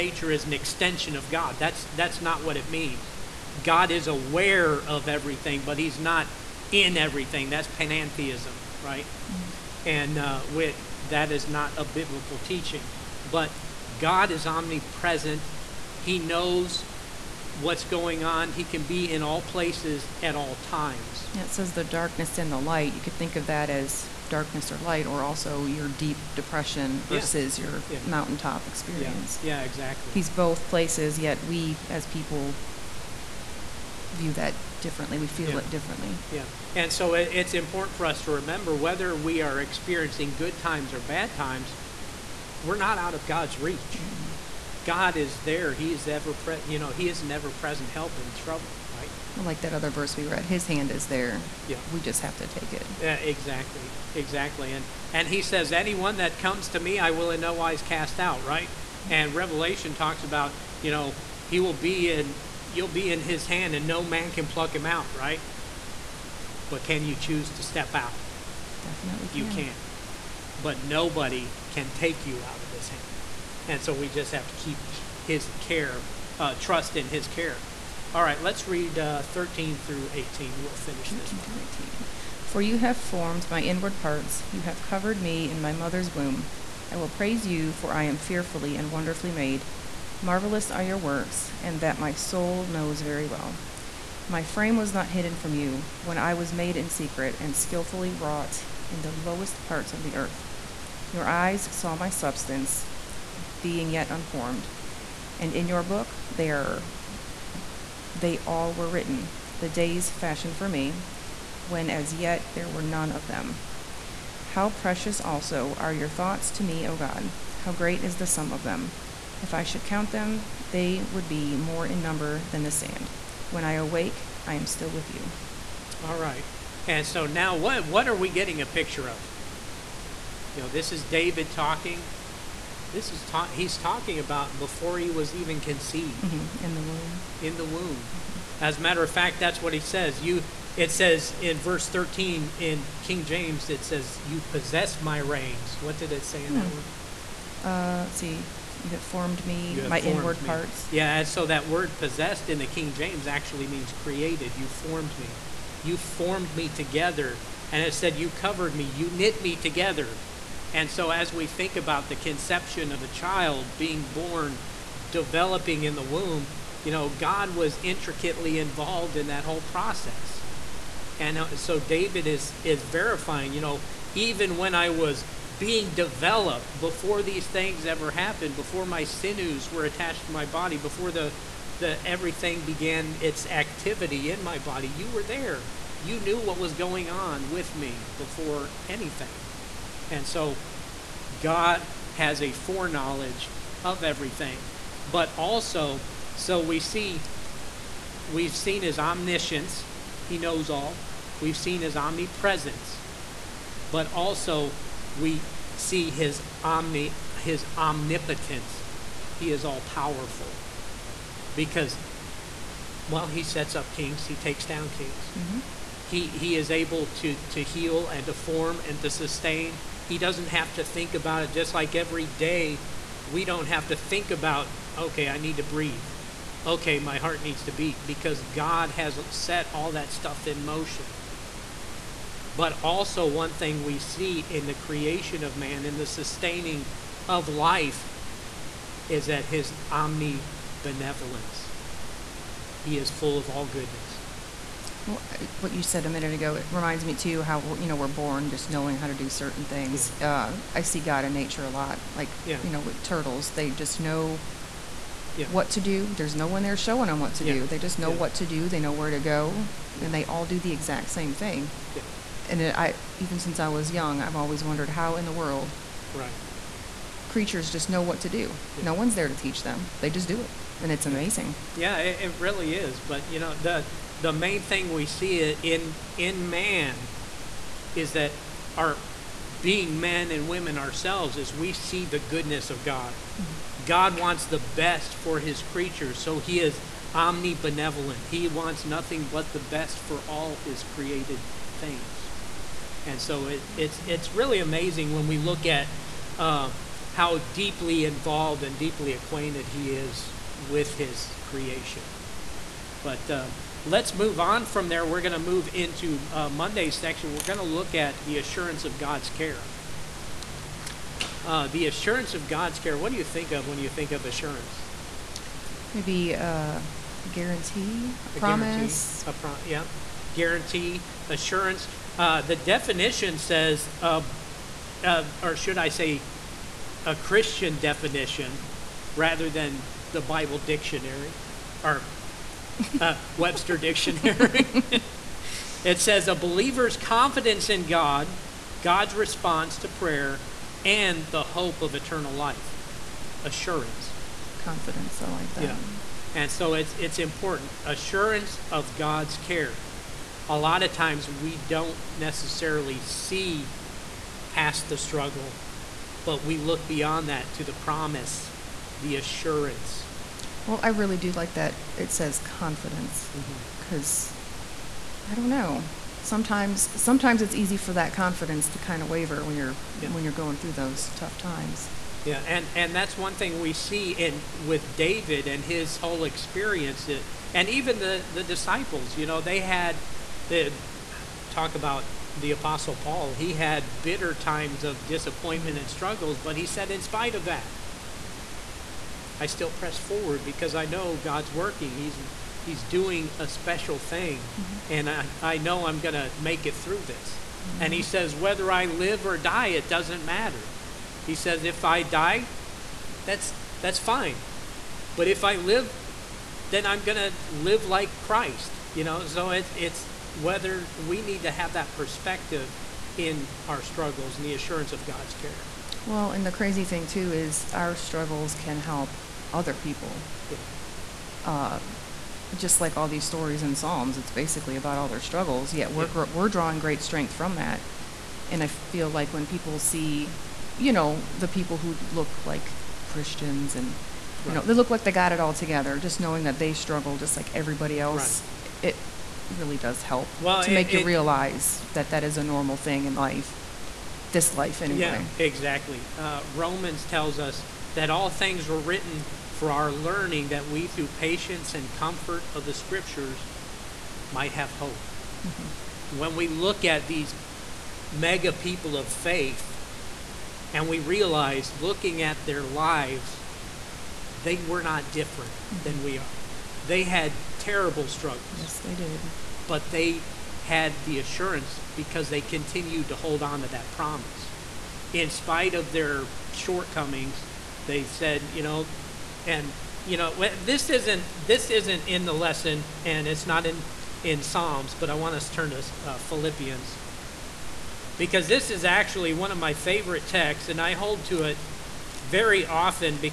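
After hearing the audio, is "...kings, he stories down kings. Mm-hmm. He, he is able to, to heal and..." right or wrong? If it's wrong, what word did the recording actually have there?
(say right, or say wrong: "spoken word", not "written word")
wrong: "takes", not "stories".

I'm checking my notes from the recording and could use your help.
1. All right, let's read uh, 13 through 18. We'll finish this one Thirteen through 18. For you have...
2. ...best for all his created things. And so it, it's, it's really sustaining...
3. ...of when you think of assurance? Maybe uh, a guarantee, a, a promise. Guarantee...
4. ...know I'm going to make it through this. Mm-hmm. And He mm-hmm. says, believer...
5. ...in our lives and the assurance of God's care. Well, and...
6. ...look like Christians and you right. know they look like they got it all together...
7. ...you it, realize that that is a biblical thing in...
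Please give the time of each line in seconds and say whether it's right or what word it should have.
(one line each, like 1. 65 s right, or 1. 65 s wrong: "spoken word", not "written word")
1. 78 s right
2. 289 s wrong: "amazing", not "sustaining"
3. 313 s right
4. 395 s wrong: "whether", not "believer"
5. 413 s wrong: "struggles", not "lives"
6. 432 s right
7. 440 s wrong: "normal", not "biblical".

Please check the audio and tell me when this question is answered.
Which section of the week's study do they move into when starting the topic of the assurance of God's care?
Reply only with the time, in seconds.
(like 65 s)
306 s.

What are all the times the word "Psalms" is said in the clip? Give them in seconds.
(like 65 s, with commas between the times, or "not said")
423 s, 484 s.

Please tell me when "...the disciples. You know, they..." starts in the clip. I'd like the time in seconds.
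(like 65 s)
378 s.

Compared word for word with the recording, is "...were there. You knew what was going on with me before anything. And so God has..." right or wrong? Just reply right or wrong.
right.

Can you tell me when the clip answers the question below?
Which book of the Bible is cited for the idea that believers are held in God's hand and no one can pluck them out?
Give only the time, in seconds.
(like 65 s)
59 s.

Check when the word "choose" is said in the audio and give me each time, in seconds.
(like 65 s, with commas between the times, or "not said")
67 s.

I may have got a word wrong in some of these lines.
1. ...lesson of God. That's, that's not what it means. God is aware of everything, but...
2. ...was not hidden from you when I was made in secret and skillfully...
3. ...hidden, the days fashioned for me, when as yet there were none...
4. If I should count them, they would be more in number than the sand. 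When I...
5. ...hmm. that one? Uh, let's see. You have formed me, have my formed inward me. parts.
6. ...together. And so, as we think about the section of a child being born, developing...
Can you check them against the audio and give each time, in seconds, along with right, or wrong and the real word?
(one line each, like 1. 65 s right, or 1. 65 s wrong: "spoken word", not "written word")
1. 0 s wrong: "extension", not "lesson"
2. 94 s right
3. 108 s wrong: "written", not "hidden"
4. 119 s right
5. 146 s right
6. 159 s wrong: "conception", not "section".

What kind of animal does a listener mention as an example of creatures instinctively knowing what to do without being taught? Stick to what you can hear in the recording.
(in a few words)
Turtles.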